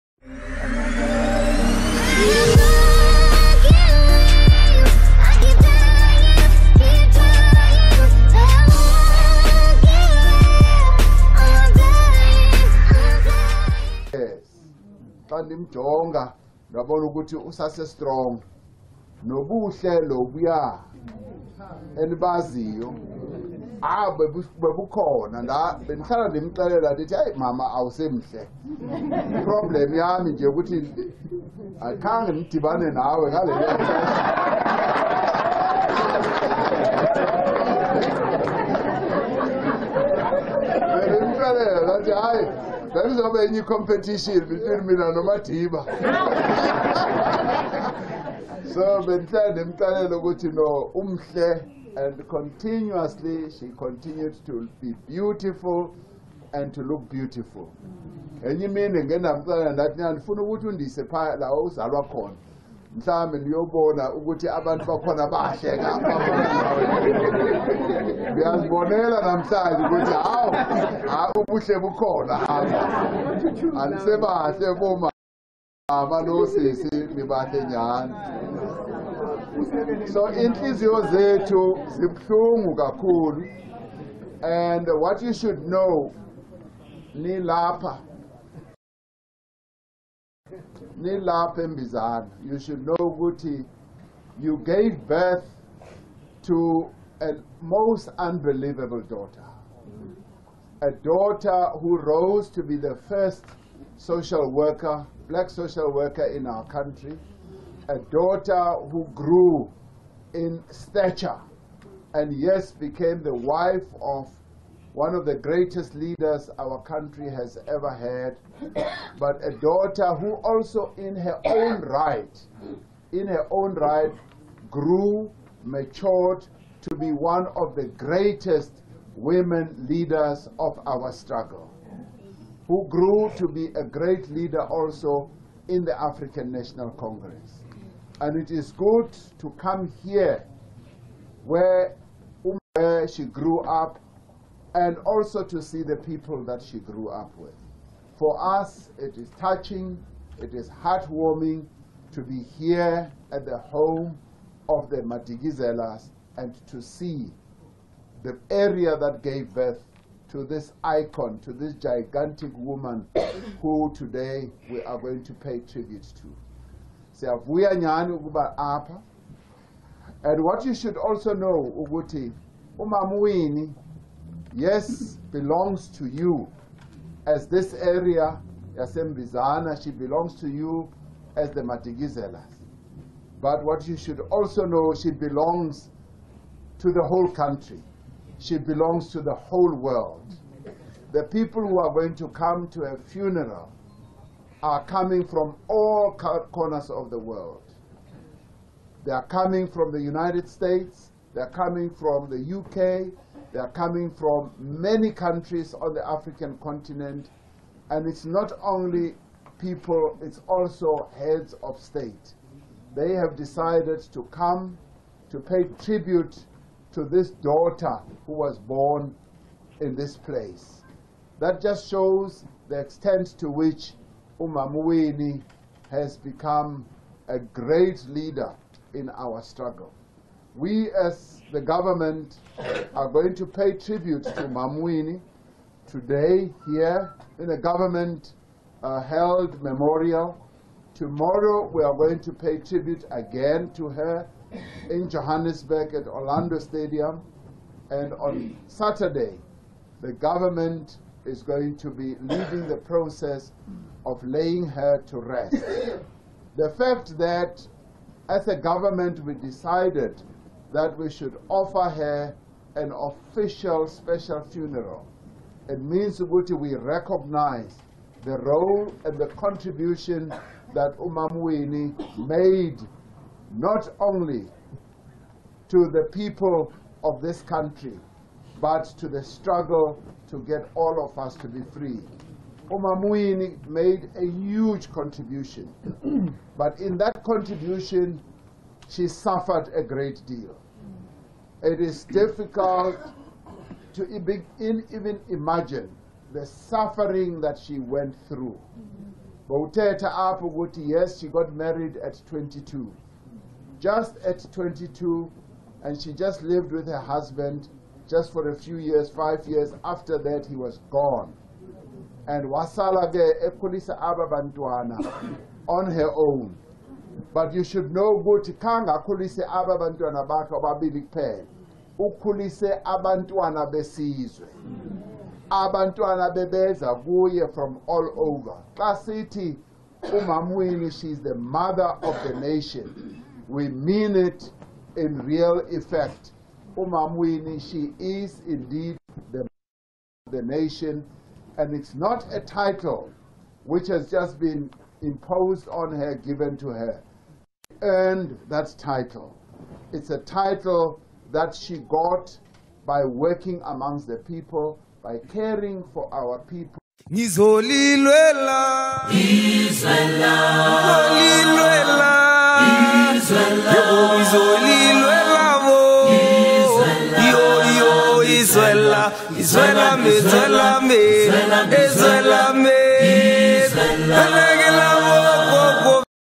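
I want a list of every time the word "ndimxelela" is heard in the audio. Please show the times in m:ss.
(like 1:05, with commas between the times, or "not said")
0:26, 0:49.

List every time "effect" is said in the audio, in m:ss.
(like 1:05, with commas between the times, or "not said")
5:35.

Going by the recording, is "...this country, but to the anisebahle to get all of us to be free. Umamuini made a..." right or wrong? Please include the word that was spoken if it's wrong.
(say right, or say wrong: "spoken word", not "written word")
wrong: "struggle", not "anisebahle".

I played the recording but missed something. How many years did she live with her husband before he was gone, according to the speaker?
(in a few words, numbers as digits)
5 years.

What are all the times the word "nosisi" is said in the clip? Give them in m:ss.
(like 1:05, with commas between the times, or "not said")
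1:16.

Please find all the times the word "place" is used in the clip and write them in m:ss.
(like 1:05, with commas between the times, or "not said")
3:40.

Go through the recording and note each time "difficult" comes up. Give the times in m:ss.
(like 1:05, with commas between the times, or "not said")
4:52.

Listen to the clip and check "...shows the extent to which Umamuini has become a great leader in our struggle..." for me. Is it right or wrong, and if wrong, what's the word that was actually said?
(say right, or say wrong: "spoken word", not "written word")
right.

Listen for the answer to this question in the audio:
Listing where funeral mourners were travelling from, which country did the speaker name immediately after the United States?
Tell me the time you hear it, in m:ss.
3:22.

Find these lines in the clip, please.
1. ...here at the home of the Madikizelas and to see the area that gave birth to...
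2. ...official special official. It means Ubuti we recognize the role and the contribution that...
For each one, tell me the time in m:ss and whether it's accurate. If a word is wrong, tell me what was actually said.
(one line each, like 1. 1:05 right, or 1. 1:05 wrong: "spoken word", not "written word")
1. 2:32 right
2. 4:22 wrong: "funeral", not "official".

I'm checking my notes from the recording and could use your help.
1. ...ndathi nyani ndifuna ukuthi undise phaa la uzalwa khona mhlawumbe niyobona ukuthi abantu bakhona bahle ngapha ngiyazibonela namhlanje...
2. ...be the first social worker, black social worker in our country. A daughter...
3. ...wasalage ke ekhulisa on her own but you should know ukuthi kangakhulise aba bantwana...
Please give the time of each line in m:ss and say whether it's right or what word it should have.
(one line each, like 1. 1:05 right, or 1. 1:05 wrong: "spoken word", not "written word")
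1. 0:59 right
2. 1:42 right
3. 5:12 right.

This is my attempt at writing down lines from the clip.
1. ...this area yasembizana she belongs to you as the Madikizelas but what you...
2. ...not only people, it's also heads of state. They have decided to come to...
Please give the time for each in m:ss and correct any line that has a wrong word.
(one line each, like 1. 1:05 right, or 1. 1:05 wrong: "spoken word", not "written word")
1. 2:57 right
2. 3:28 right.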